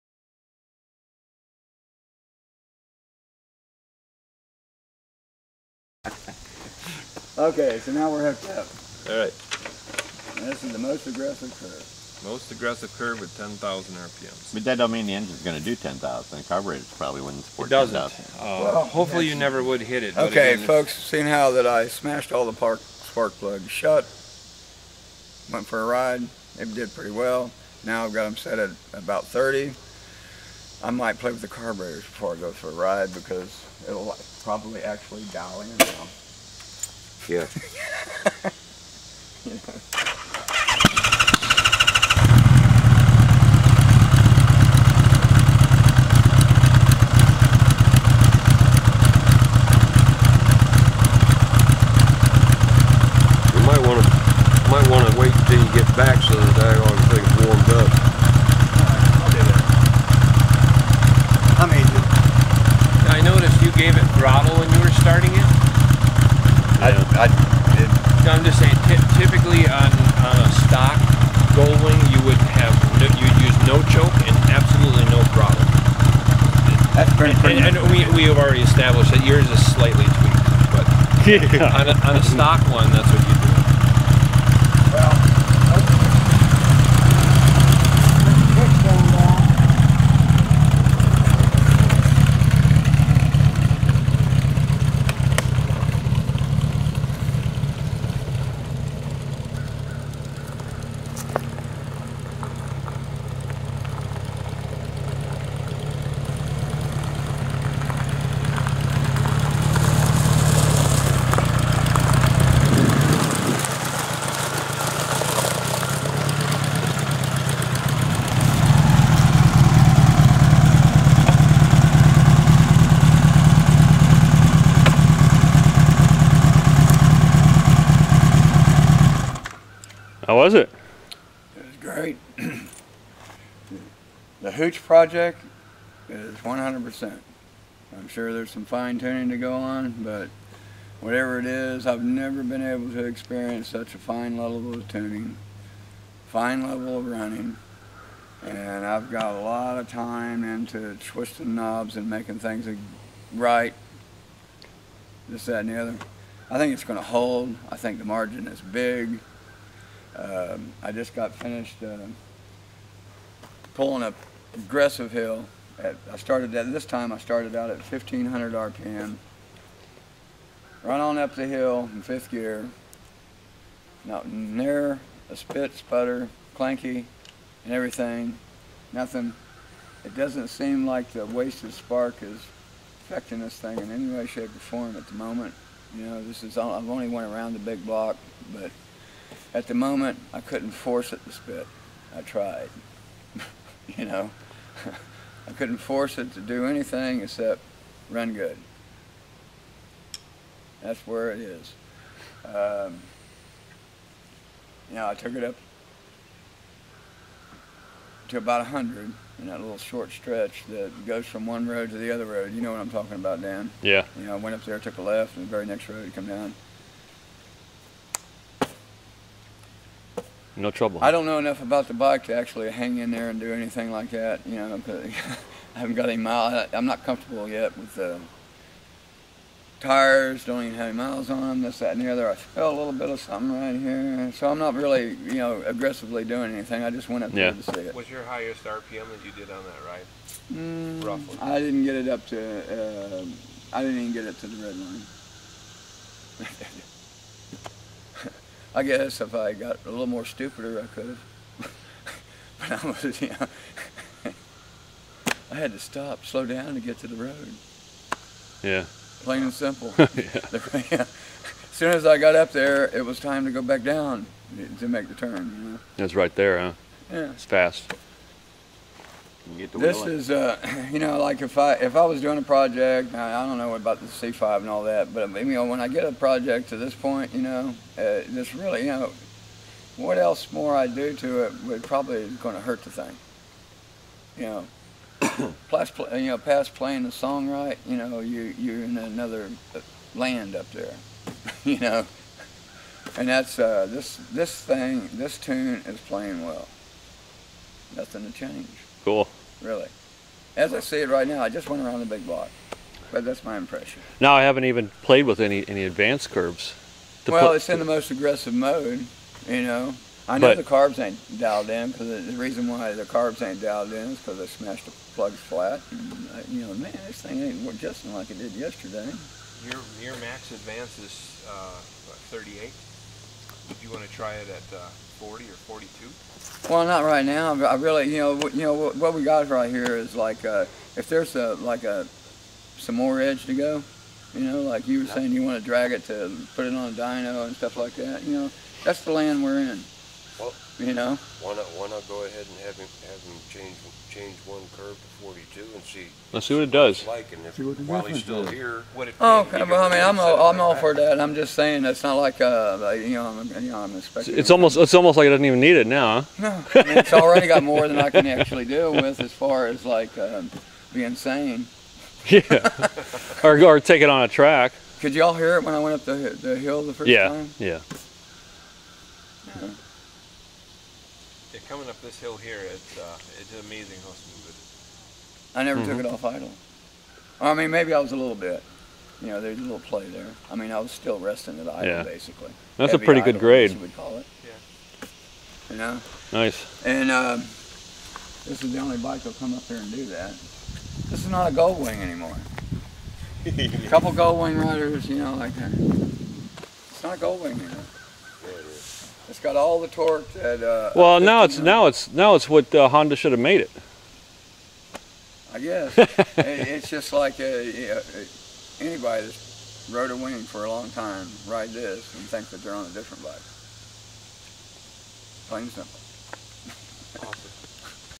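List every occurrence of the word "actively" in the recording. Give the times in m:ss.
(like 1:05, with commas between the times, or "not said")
not said.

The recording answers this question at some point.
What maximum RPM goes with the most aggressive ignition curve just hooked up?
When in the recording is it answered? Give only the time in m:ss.
0:13.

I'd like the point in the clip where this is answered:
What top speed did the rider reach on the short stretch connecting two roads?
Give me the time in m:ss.
3:28.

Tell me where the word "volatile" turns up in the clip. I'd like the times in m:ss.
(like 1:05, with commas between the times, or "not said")
not said.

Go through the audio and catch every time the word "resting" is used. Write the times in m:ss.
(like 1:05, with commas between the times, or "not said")
6:21.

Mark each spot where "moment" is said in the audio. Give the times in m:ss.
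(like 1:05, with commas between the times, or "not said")
3:05, 3:09.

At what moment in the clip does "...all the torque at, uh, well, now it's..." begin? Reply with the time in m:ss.
6:39.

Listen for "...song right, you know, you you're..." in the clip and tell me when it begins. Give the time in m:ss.
4:47.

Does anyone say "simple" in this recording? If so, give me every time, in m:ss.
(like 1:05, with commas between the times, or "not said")
4:19, 6:55.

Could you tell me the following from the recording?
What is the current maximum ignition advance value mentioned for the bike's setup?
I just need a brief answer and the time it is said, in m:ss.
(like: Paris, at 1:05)
38, at 5:22.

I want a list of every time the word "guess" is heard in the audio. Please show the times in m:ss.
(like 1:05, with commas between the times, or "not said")
4:08, 6:45.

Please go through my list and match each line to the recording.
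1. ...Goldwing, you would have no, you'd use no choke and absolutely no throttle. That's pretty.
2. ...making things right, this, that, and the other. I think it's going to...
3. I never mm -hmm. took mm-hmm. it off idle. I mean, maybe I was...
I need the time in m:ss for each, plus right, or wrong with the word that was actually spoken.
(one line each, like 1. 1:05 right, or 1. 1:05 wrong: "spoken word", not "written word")
1. 1:11 right
2. 2:32 right
3. 6:15 right.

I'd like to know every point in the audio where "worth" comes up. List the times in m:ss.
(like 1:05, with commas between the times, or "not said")
not said.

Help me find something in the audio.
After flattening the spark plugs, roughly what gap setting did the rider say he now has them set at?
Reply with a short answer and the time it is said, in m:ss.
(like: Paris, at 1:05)
30, at 0:28.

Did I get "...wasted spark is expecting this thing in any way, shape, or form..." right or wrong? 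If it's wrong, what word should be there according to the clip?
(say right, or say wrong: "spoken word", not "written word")
wrong: "affecting", not "expecting".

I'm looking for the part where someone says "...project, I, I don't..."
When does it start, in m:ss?
4:32.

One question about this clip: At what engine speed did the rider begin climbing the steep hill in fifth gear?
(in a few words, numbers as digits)
1500 RPM.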